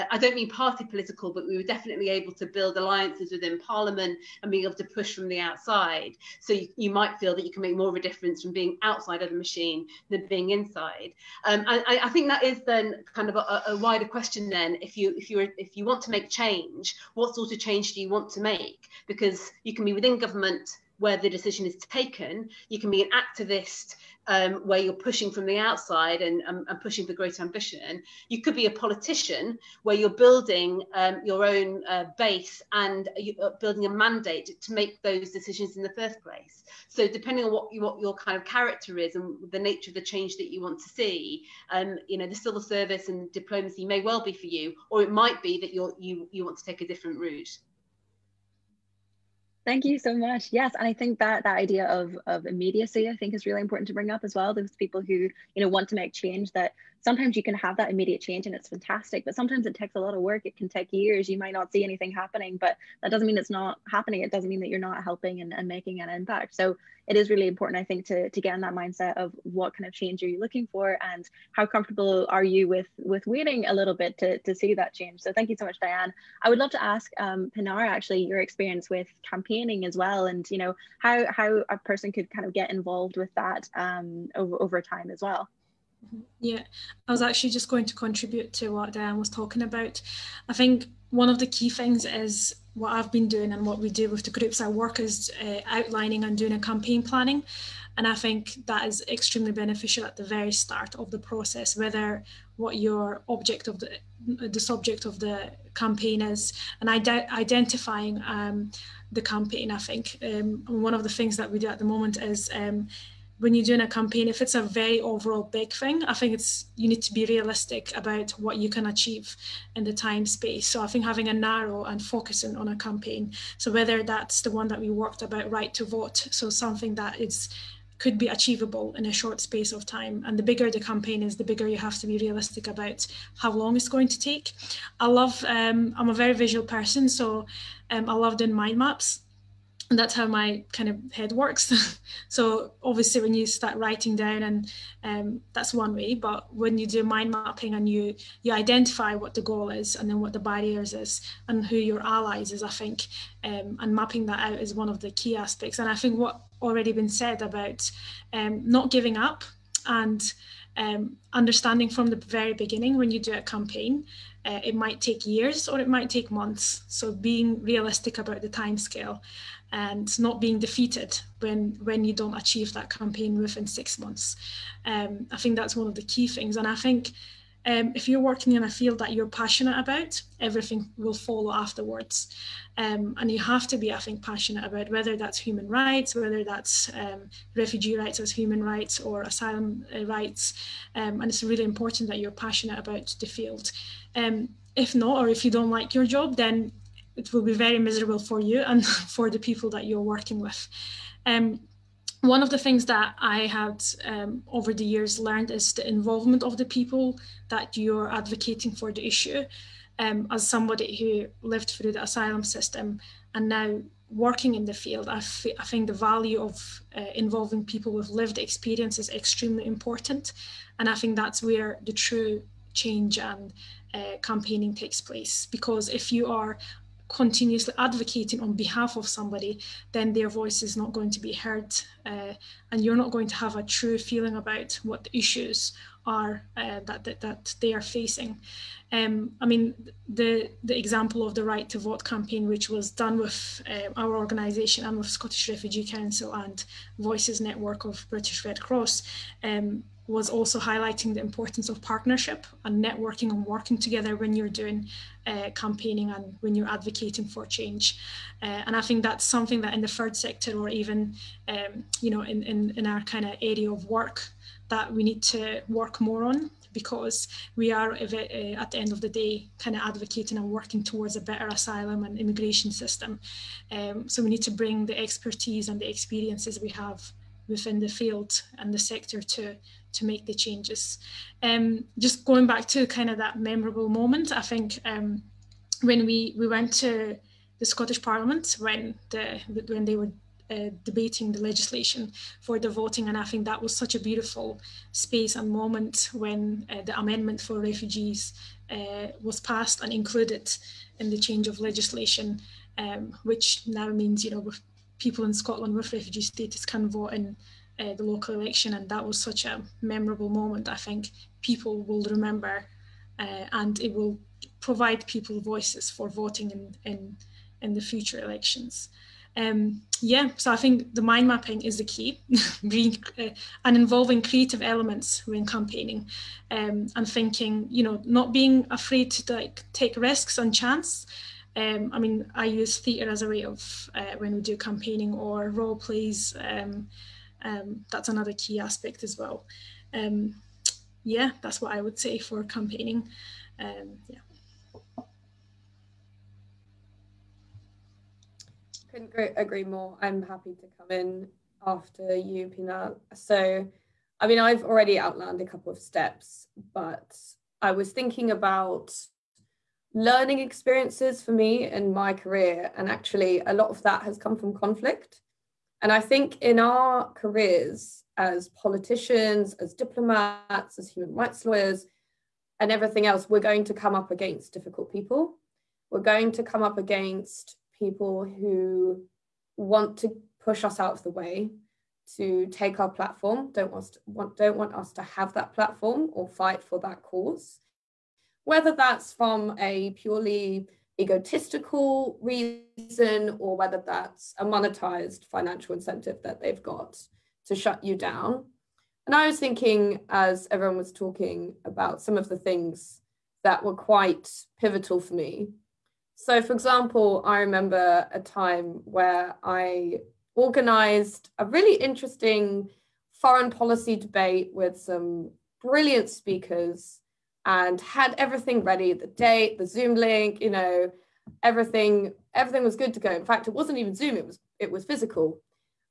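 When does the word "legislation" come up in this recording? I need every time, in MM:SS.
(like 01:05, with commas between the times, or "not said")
04:51, 05:01.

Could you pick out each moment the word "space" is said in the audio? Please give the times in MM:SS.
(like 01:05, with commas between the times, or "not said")
02:00, 02:09, 04:54.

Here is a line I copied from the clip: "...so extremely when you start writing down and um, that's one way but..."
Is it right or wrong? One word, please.
wrong.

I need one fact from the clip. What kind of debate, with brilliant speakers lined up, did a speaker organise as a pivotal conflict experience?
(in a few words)
foreign policy debate.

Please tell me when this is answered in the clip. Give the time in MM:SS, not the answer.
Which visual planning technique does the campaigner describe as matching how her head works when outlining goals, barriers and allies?
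02:18.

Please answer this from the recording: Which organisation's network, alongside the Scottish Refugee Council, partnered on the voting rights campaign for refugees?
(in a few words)
British Red Cross.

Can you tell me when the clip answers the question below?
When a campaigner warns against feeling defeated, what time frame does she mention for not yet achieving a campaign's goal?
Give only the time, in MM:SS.
02:53.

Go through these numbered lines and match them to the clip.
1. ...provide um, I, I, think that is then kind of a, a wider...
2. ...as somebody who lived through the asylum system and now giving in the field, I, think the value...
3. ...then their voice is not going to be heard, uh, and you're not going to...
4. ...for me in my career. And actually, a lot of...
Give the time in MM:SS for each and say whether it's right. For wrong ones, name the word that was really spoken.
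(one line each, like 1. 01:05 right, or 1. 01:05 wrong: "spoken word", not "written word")
1. 00:10 wrong: "inside", not "provide"
2. 03:30 wrong: "working", not "giving"
3. 03:49 right
4. 06:01 right.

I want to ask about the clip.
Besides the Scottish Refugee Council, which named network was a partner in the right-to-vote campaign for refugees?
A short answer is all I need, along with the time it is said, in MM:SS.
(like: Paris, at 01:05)
Voices Network, at 04:06.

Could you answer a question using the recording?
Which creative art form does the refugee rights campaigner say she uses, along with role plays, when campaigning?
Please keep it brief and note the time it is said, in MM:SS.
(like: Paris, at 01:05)
theatre, at 05:32.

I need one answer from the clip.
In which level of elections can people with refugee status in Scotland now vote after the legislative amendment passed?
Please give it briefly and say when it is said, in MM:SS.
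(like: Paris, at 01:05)
local election, at 05:08.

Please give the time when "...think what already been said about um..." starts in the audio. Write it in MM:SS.
02:35.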